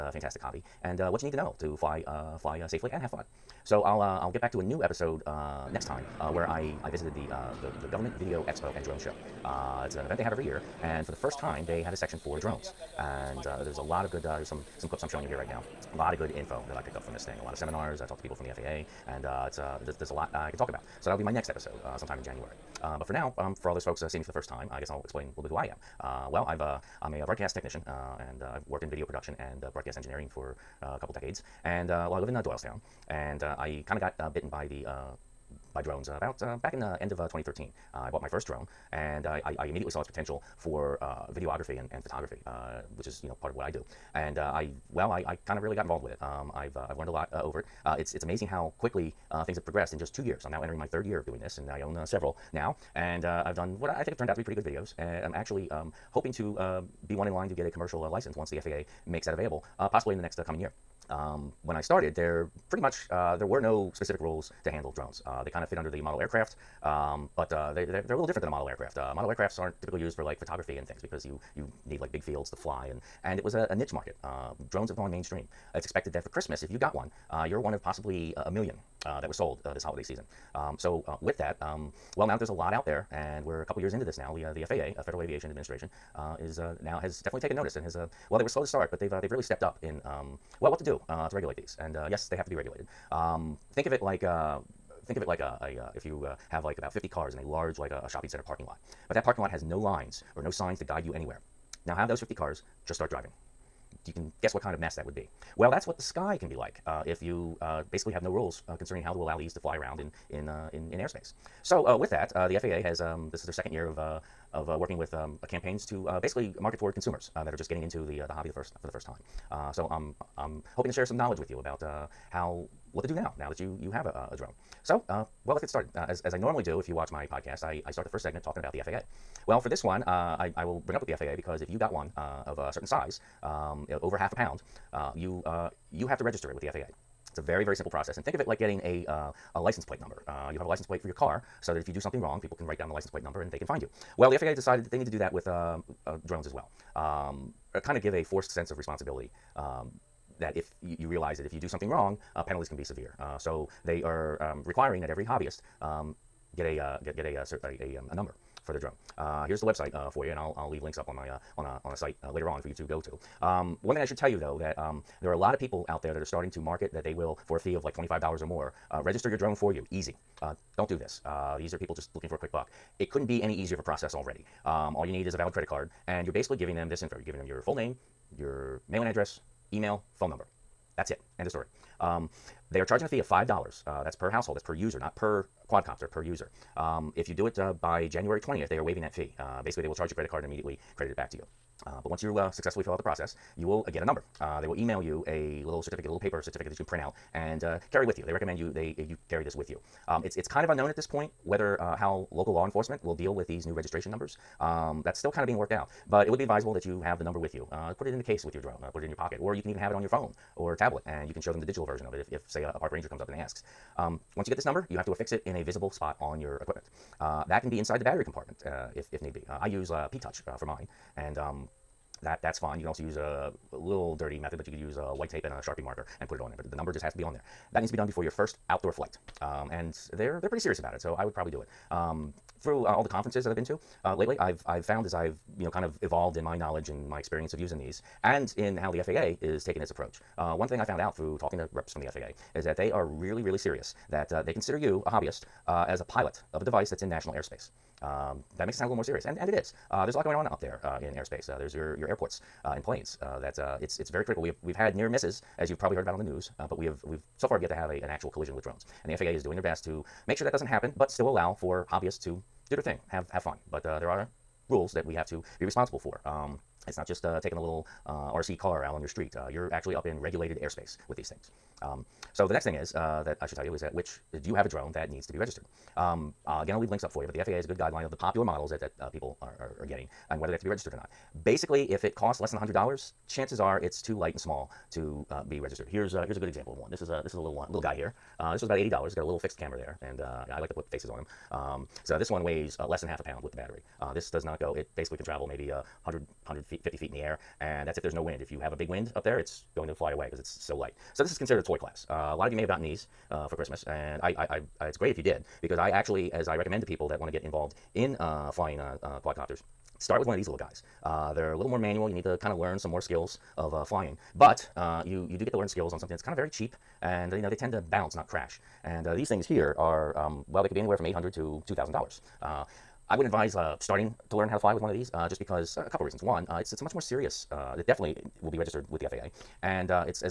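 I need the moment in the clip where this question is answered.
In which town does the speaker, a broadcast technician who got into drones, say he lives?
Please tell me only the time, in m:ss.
0:32.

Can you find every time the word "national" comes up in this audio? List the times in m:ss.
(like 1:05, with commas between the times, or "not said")
4:07.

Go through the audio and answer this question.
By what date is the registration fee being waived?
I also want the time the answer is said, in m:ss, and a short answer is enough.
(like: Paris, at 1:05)
January 20th, at 3:08.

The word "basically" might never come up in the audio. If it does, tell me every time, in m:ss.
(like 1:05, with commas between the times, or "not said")
1:47, 1:56, 2:56, 3:09, 4:41, 4:54.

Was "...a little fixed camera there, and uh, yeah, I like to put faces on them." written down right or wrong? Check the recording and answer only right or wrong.
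right.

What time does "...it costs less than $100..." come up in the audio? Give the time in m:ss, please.
4:42.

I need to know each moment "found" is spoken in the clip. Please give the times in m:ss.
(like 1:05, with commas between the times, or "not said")
3:54, 4:00.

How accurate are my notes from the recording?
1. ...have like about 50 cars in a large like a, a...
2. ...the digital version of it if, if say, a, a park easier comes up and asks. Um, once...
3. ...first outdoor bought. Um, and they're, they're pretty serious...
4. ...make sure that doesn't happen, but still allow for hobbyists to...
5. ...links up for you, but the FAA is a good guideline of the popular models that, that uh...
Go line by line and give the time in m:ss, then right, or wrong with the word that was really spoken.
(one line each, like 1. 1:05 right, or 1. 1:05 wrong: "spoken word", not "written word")
1. 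1:36 right
2. 3:31 wrong: "ranger", not "easier"
3. 3:48 wrong: "flight", not "bought"
4. 4:20 right
5. 4:36 right.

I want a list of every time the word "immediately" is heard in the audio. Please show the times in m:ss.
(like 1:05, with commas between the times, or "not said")
0:39, 3:10.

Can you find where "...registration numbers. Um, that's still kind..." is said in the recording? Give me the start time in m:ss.
3:23.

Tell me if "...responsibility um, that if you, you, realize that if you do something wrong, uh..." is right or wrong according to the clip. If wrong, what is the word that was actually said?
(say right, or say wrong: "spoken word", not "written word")
right.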